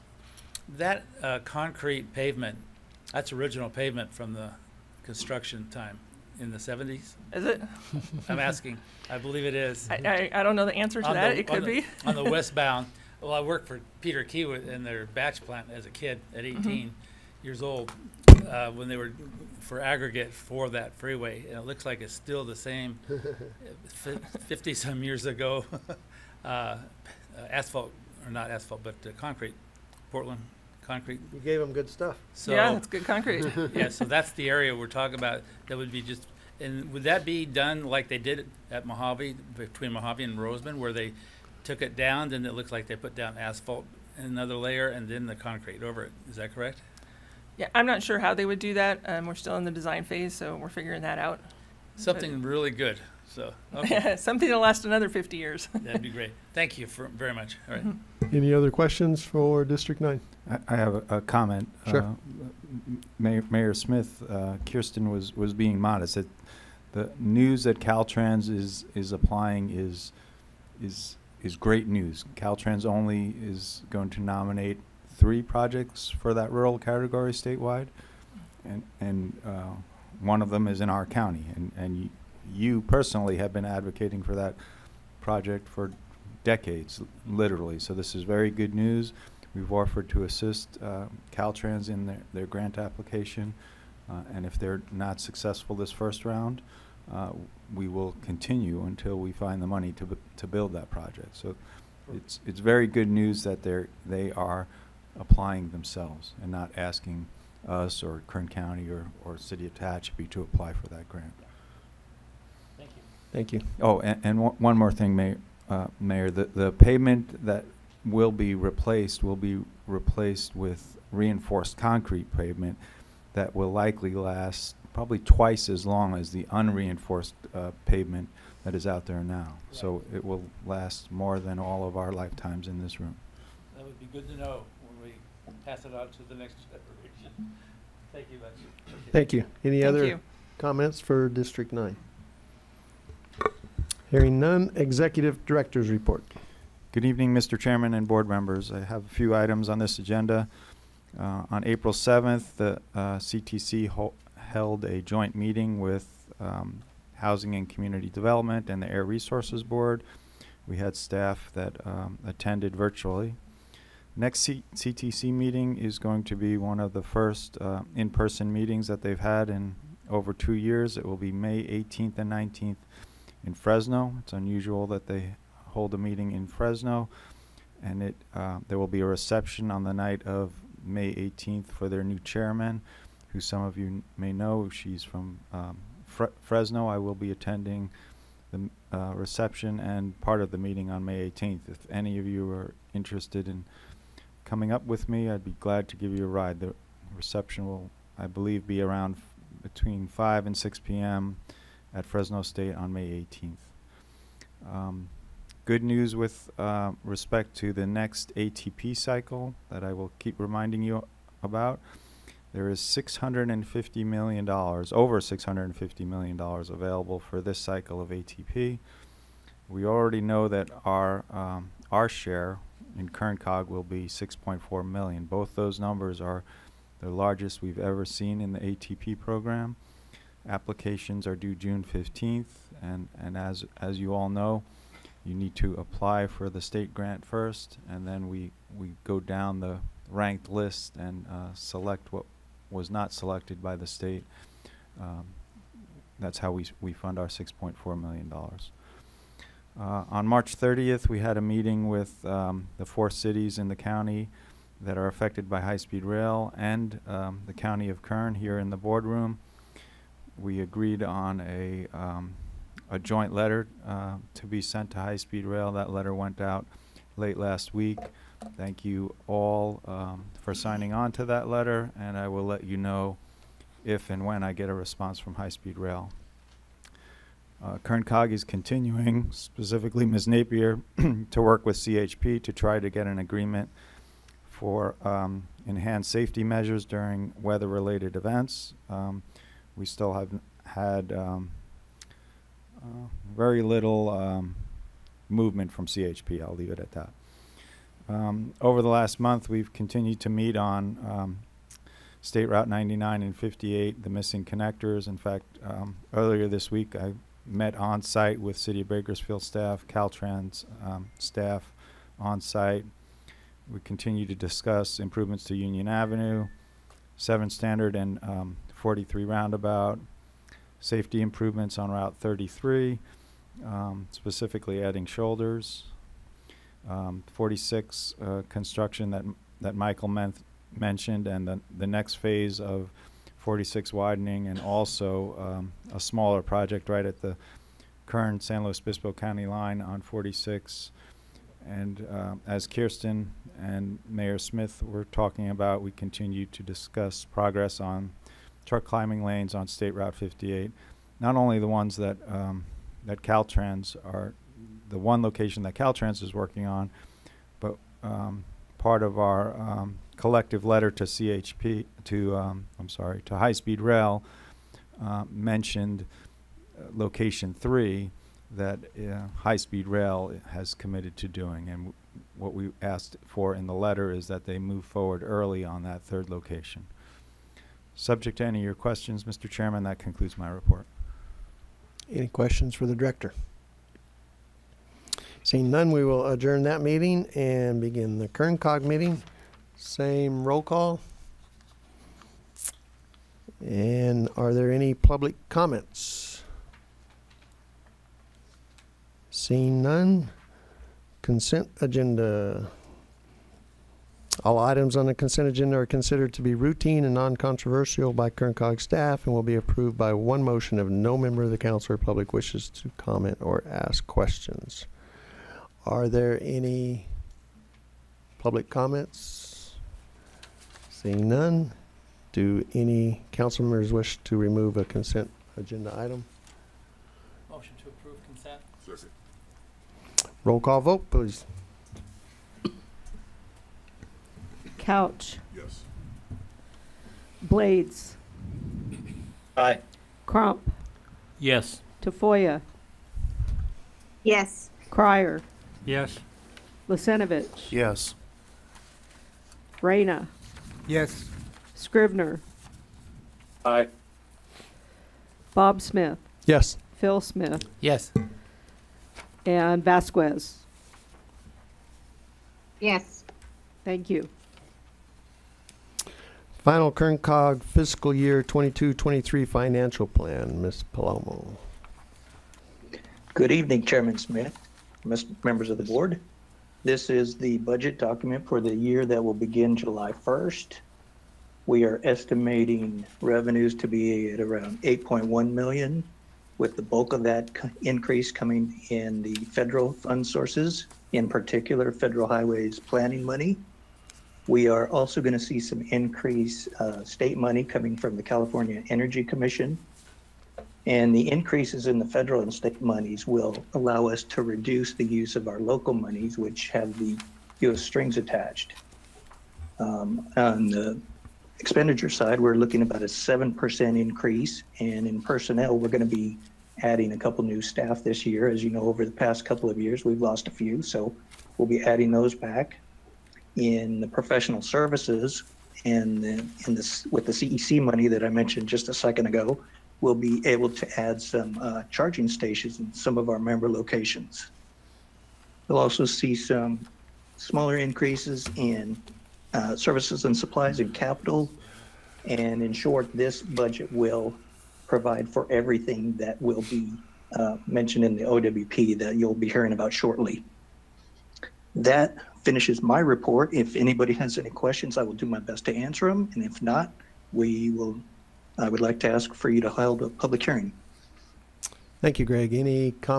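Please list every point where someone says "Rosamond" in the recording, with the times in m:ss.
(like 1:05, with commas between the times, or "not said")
0:40.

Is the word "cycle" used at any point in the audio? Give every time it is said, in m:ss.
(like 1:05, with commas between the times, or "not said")
3:28, 3:37.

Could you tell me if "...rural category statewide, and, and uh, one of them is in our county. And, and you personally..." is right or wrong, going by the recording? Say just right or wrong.
right.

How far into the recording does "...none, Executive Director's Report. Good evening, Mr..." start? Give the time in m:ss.
2:24.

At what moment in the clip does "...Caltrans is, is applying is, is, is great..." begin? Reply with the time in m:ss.
1:07.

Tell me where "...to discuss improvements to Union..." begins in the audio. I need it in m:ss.
5:14.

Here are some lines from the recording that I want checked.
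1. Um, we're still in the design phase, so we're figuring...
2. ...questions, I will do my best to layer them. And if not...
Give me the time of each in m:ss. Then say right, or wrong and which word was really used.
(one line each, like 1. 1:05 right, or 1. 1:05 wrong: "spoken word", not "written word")
1. 0:49 right
2. 9:14 wrong: "answer", not "layer".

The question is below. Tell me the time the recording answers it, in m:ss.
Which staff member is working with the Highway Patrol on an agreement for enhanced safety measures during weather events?
4:40.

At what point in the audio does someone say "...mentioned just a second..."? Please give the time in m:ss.
8:48.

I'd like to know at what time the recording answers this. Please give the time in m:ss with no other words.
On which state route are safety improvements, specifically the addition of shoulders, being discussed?
5:21.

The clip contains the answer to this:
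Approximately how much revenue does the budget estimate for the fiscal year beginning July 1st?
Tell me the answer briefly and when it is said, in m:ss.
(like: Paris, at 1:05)
8.1 million, at 8:04.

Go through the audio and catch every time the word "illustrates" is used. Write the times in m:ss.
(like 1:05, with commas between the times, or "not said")
not said.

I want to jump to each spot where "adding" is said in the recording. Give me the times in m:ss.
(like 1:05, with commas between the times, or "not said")
5:24, 8:36, 8:41.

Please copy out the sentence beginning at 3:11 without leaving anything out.
If any of you are interested in coming up with me, I'd be glad to give you a ride.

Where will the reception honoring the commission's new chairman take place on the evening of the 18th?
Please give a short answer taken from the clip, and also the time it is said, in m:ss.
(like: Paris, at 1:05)
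Fresno State, at 3:22.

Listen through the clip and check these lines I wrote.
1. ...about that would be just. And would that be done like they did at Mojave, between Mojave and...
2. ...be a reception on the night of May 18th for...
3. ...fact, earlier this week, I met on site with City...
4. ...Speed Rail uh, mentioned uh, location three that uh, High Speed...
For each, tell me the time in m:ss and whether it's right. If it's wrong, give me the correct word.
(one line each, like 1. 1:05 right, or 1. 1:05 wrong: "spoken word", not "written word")
1. 0:35 right
2. 2:58 right
3. 5:05 right
4. 6:03 right.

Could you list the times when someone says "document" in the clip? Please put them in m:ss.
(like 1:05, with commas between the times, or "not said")
7:57.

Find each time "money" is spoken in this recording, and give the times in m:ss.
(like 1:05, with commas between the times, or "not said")
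1:39, 8:13, 8:17, 8:47.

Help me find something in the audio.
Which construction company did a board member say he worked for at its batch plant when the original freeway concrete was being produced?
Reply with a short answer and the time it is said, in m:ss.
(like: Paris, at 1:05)
Peter Kiewit, at 0:14.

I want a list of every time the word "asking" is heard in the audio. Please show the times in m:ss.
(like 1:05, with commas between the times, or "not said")
0:08, 1:46.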